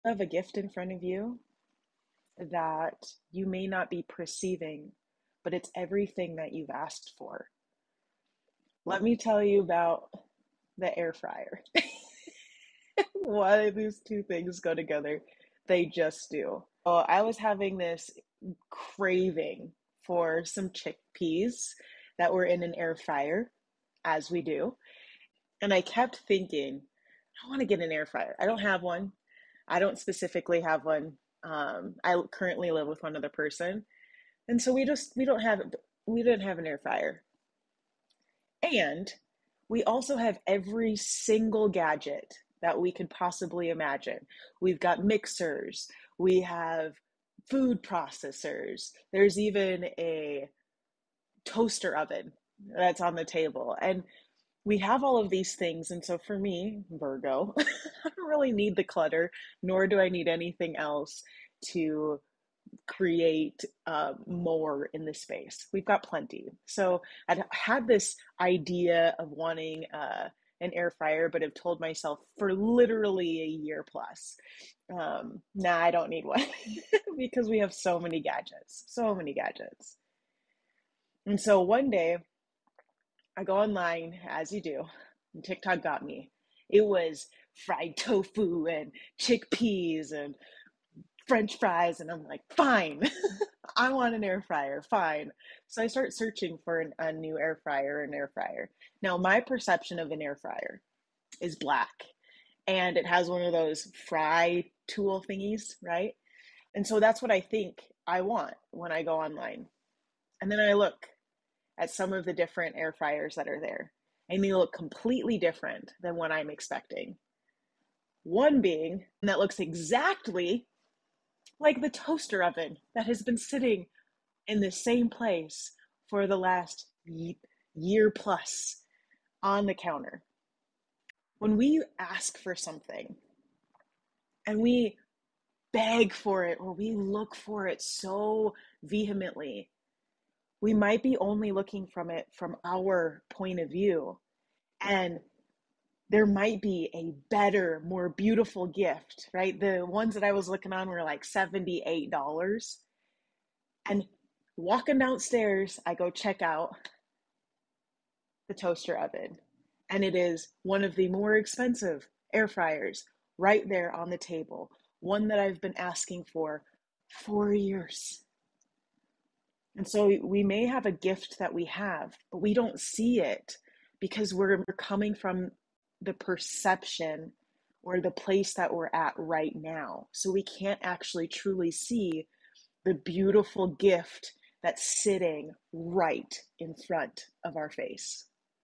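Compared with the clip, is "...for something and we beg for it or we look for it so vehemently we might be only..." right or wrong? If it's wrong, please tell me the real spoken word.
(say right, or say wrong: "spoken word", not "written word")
right.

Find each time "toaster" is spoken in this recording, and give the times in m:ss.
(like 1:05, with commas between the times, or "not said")
0:51, 2:01, 2:38.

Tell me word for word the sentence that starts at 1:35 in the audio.
So I start searching for an, a new air fryer, an air fryer.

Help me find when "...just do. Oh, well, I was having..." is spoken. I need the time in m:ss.
0:15.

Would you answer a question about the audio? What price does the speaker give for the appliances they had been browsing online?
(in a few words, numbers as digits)
$78.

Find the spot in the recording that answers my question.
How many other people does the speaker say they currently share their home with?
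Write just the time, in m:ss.
0:33.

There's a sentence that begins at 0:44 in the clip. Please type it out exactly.
We've got mixers, we have food processors.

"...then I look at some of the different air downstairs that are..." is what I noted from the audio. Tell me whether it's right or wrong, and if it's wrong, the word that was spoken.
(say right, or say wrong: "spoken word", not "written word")
wrong: "fryers", not "downstairs".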